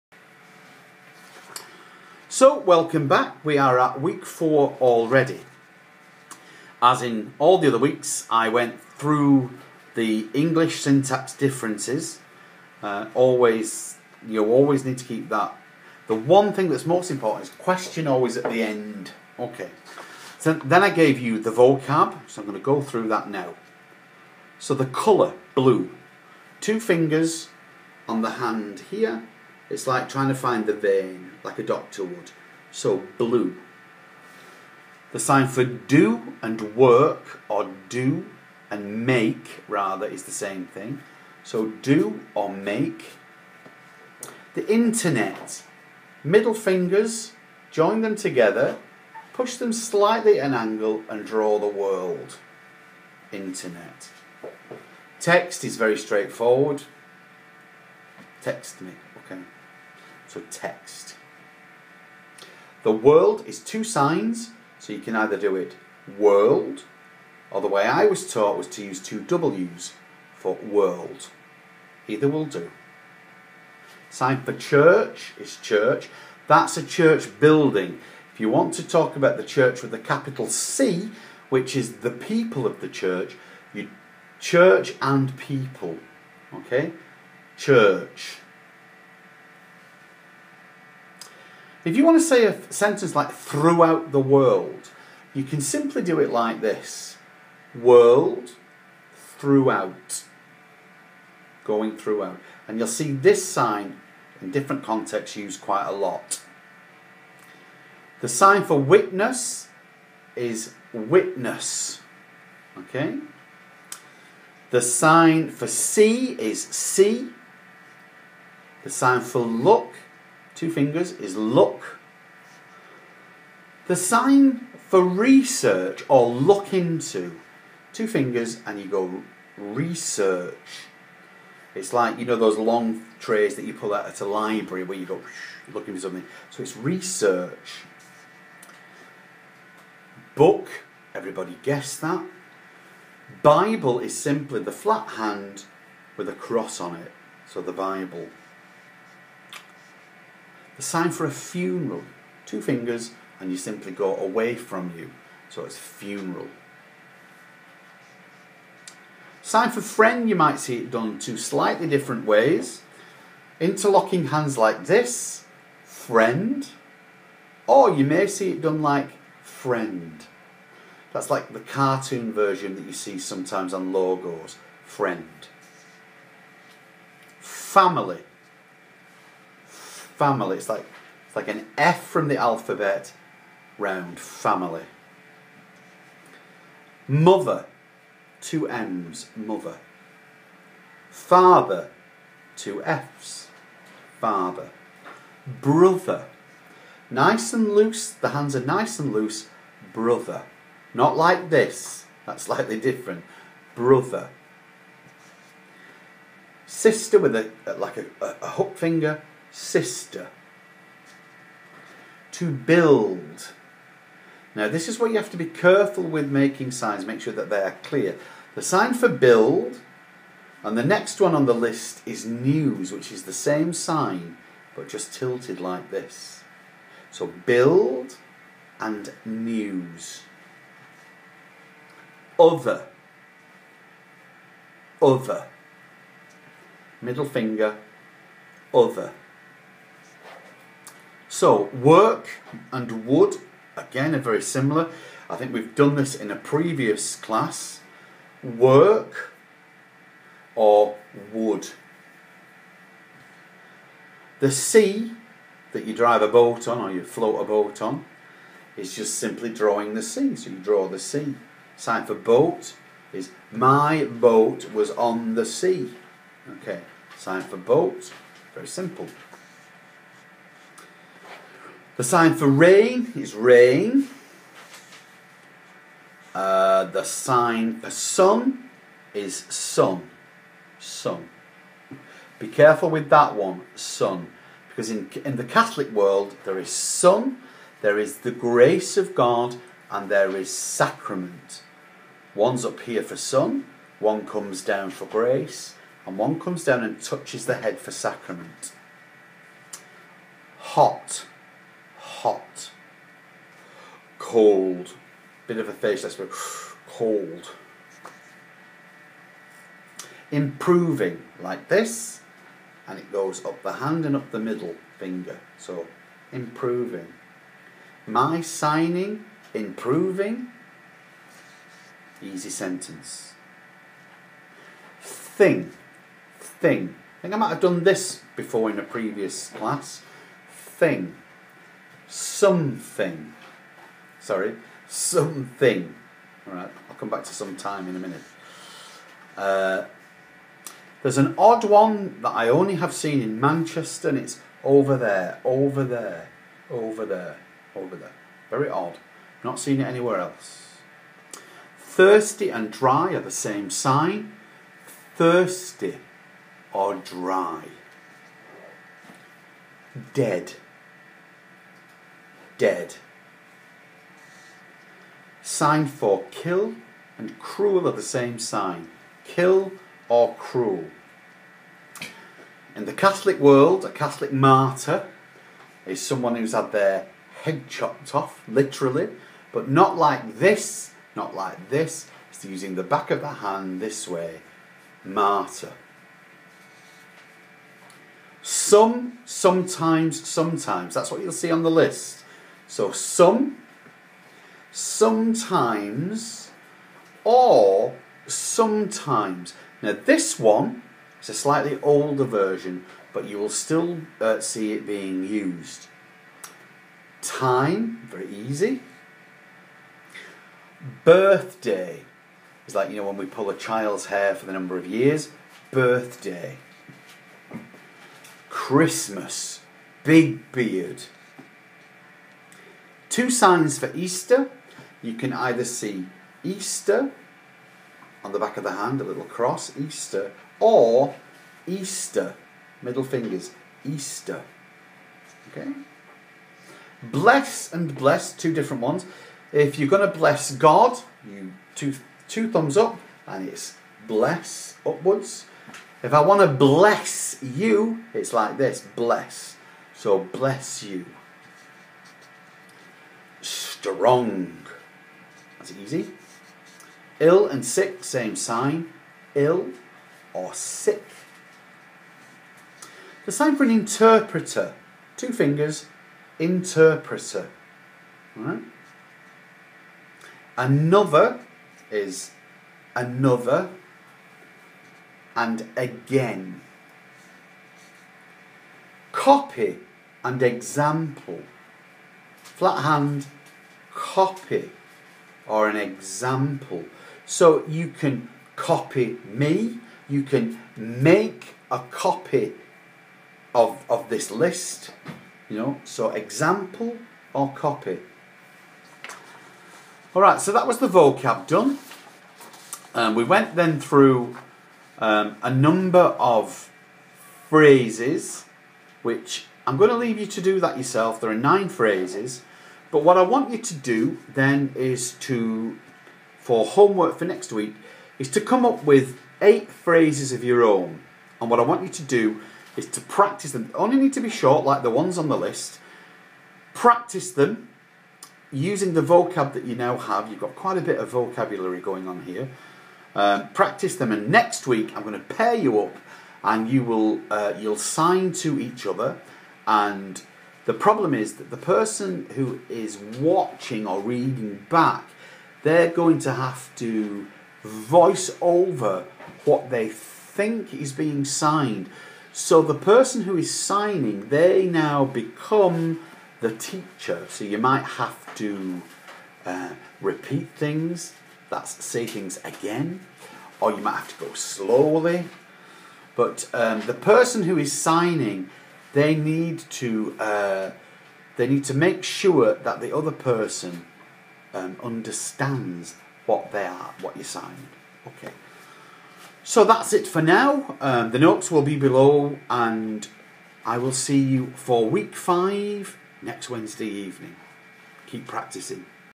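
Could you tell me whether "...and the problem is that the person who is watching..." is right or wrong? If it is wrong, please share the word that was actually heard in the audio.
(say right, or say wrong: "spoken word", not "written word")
right.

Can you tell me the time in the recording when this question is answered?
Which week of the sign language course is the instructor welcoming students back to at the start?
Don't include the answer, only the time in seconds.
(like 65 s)
4 s.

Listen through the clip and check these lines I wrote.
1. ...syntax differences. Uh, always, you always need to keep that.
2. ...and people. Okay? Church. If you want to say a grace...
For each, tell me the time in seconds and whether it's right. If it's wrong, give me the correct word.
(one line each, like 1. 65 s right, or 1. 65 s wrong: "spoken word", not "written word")
1. 10 s right
2. 85 s wrong: "sentence", not "grace".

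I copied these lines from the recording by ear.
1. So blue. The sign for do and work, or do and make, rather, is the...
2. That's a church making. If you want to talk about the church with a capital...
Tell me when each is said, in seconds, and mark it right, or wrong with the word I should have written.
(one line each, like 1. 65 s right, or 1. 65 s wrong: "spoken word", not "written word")
1. 32 s right
2. 76 s wrong: "building", not "making".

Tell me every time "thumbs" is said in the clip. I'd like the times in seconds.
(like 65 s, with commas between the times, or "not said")
442 s.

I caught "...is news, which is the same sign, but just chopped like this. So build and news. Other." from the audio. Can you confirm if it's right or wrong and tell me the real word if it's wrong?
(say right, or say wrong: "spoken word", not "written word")
wrong: "tilted", not "chopped".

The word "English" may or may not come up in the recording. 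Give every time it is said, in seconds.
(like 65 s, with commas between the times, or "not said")
10 s.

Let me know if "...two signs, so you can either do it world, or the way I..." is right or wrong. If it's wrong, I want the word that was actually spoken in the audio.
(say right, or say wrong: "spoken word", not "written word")
right.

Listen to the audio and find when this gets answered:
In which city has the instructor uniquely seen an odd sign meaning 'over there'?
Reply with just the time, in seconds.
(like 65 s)
343 s.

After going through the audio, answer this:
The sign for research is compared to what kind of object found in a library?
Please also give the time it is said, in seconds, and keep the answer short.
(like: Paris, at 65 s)
long trays, at 132 s.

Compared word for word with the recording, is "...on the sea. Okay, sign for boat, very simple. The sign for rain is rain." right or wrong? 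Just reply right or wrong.
right.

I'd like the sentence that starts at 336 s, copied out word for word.
All right, I'll come back to some time in a minute.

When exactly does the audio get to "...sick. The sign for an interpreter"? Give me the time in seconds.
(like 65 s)
460 s.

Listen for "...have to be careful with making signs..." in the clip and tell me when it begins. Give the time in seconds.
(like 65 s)
215 s.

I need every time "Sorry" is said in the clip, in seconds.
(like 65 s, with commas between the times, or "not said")
334 s.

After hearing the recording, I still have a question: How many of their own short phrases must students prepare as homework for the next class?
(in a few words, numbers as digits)
8.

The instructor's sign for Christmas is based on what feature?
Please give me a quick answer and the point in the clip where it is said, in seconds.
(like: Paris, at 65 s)
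Big beard, at 420 s.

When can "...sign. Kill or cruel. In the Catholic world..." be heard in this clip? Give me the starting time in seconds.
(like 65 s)
368 s.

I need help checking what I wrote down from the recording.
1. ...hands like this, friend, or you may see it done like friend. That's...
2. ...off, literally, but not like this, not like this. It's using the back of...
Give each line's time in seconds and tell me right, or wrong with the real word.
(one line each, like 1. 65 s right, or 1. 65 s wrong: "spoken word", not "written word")
1. 164 s right
2. 378 s right.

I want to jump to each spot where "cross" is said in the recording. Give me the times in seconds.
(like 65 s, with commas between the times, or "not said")
146 s, 429 s.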